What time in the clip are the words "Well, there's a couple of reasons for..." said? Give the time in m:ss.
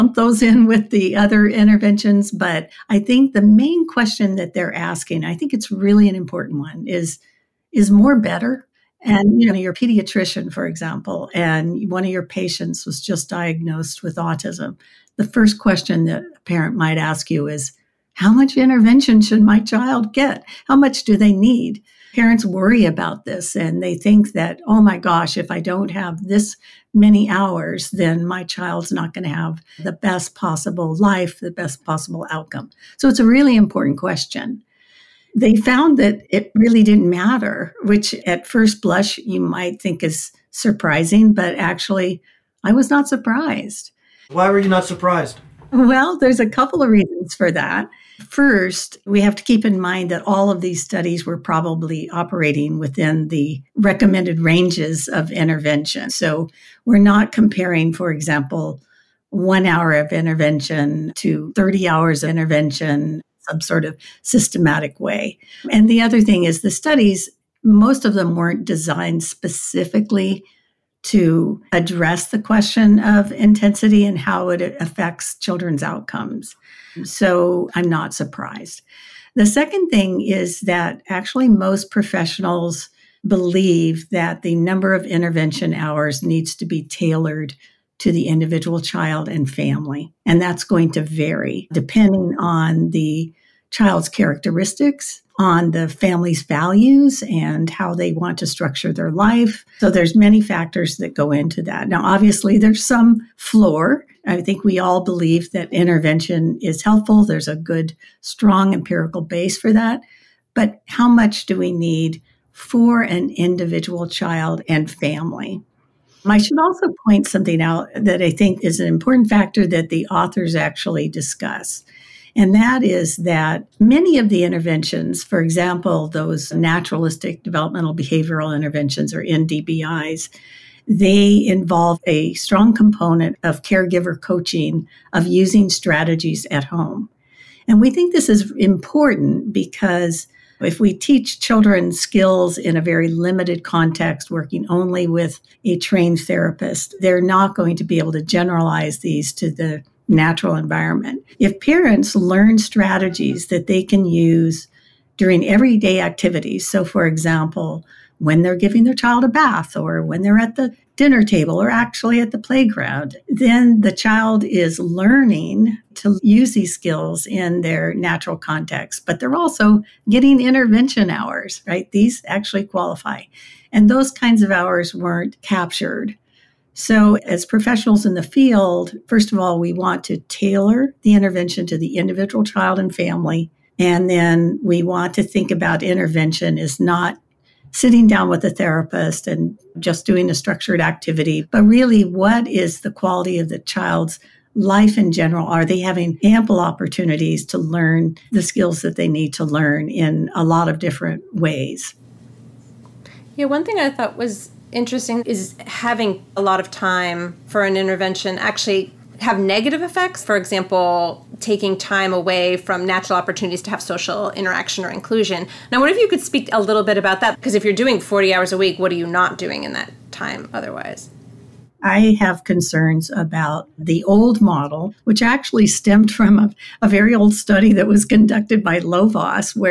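0:45.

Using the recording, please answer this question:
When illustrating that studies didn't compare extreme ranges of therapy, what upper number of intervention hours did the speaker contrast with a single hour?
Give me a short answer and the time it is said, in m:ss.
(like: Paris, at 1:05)
30 hours, at 1:01.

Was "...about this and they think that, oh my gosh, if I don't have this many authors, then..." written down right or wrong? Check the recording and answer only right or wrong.
wrong.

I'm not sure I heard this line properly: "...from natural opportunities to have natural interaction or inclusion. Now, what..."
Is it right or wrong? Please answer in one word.
wrong.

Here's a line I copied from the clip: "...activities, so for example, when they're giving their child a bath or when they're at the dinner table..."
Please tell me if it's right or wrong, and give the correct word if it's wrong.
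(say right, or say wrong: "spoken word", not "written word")
right.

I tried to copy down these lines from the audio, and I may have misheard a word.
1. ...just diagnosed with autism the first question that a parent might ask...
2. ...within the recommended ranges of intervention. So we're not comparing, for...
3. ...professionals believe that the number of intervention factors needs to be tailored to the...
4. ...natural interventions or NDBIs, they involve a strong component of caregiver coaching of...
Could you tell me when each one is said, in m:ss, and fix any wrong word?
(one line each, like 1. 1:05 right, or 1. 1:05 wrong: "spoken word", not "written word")
1. 0:13 right
2. 0:52 right
3. 1:21 wrong: "hours", not "factors"
4. 2:07 wrong: "behavioral", not "natural".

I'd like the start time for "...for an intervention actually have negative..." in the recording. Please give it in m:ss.
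3:27.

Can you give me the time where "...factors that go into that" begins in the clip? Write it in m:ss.
1:40.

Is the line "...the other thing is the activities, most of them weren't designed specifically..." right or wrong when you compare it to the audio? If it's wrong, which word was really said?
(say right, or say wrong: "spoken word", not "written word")
wrong: "studies", not "activities".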